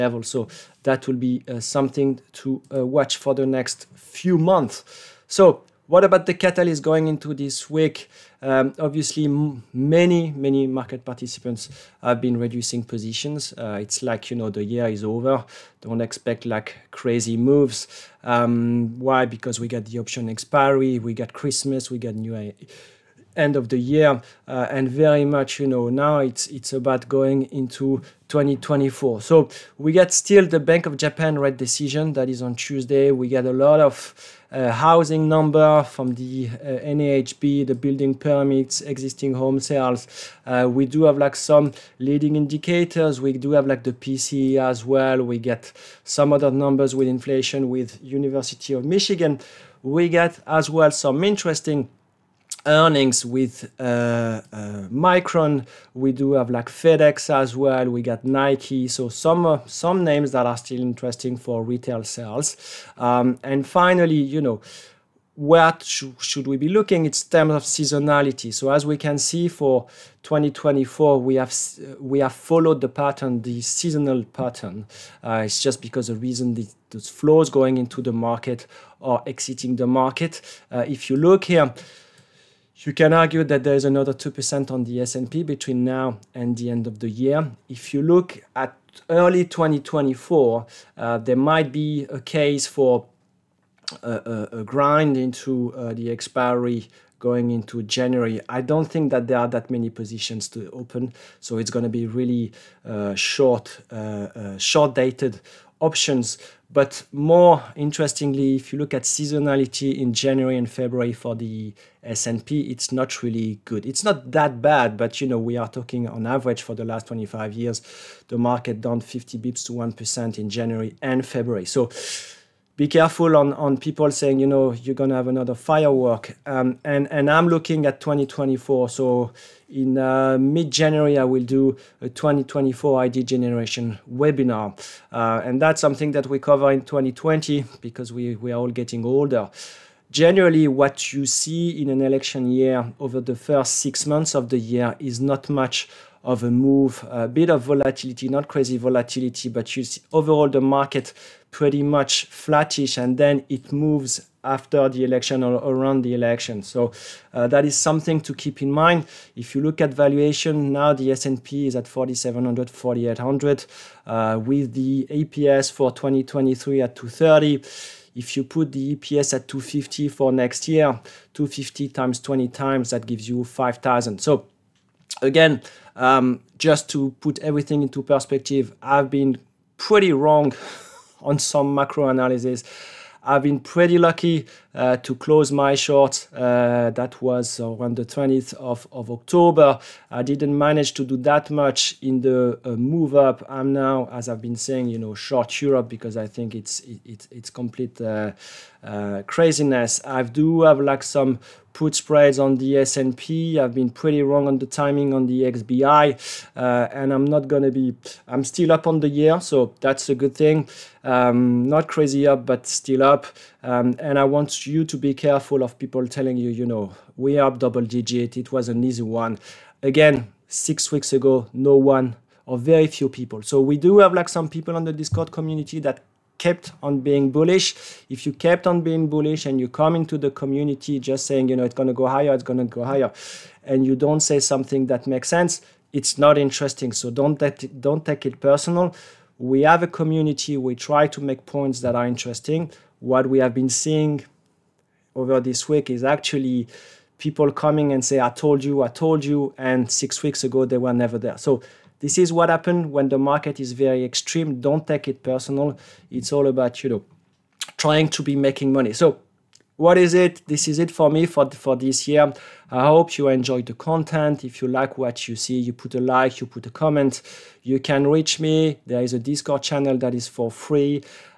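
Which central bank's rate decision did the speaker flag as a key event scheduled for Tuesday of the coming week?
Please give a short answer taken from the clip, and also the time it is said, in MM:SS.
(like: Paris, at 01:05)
Bank of Japan, at 00:30.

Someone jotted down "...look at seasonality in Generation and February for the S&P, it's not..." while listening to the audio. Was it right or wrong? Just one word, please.
wrong.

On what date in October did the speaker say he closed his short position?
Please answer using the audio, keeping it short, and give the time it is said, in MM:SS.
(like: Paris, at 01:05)
20th of October, at 03:08.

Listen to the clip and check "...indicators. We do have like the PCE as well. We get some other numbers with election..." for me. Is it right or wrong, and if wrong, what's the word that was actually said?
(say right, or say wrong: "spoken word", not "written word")
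wrong: "inflation", not "election".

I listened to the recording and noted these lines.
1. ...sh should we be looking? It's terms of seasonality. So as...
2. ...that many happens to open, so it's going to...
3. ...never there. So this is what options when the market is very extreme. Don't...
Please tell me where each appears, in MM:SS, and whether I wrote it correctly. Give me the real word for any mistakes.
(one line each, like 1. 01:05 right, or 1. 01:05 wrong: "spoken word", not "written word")
1. 01:05 right
2. 01:39 wrong: "positions", not "happens"
3. 04:10 wrong: "happens", not "options".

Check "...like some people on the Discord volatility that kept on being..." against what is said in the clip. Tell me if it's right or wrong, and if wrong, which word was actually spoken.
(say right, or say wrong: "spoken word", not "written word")
wrong: "community", not "volatility".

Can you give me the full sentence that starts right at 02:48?
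If you put the EPS at 250 for next year, 250 times 20 times, that gives you 5,000.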